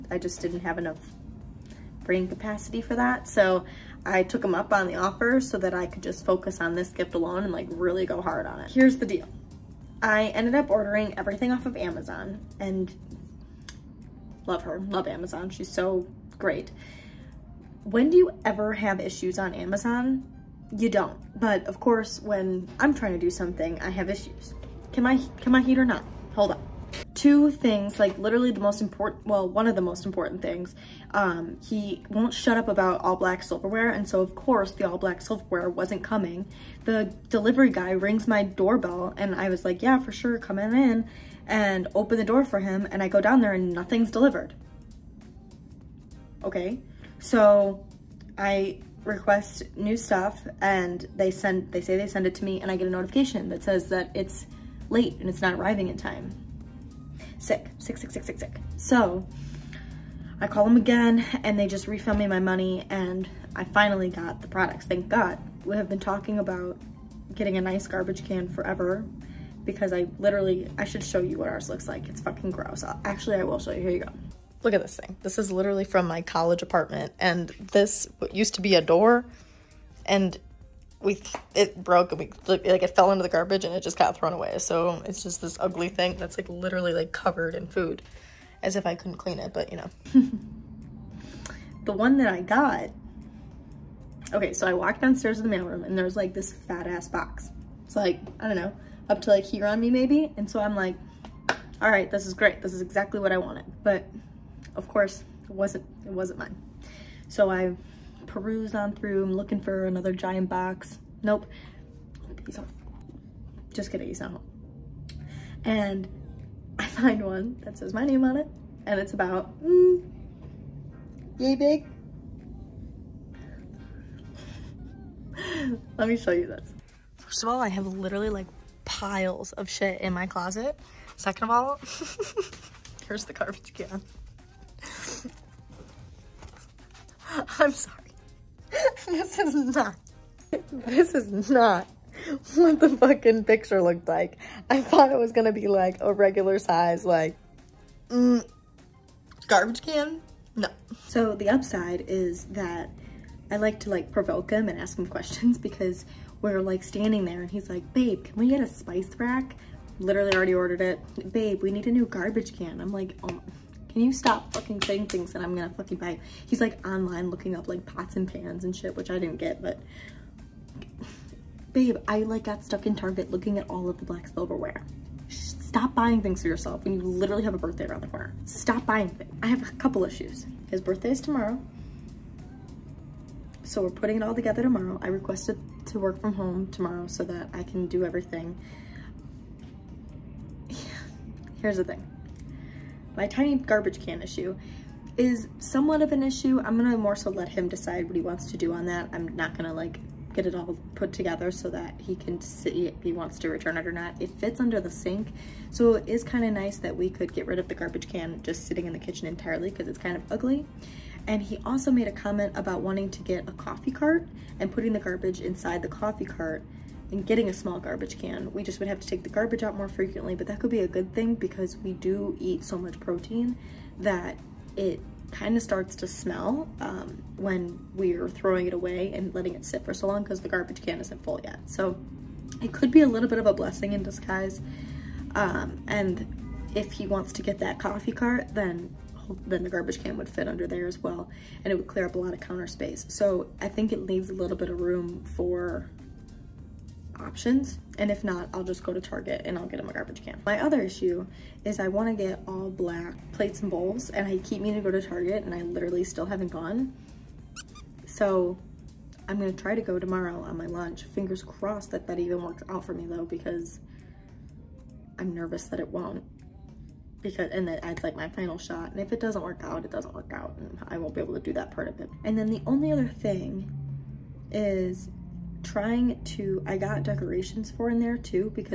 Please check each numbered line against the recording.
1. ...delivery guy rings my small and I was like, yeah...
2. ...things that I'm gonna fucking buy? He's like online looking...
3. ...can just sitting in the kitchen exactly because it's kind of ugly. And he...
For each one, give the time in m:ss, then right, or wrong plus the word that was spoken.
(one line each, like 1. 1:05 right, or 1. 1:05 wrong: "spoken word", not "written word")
1. 0:37 wrong: "doorbell", not "small"
2. 2:45 right
3. 3:28 wrong: "entirely", not "exactly".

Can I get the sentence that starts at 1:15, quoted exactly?
This is literally from my college apartment.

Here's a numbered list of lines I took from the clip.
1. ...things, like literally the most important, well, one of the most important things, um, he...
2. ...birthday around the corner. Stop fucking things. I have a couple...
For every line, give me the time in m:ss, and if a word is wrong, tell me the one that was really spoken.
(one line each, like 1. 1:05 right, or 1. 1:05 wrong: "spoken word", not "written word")
1. 0:27 right
2. 2:57 wrong: "buying", not "fucking".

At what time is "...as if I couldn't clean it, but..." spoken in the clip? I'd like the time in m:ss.
1:28.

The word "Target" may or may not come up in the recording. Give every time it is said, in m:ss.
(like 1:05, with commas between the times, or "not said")
2:52, 4:09, 4:15.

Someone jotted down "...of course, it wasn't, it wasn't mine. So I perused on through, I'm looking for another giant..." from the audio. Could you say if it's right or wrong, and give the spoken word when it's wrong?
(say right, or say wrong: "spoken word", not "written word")
right.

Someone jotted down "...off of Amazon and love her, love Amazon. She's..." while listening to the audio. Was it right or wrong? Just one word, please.
right.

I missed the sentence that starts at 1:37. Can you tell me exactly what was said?
It's like, I don't know, up to like here on me maybe.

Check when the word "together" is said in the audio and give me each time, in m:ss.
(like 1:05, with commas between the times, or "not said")
3:04, 3:21.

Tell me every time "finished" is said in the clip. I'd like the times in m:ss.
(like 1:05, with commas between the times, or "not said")
not said.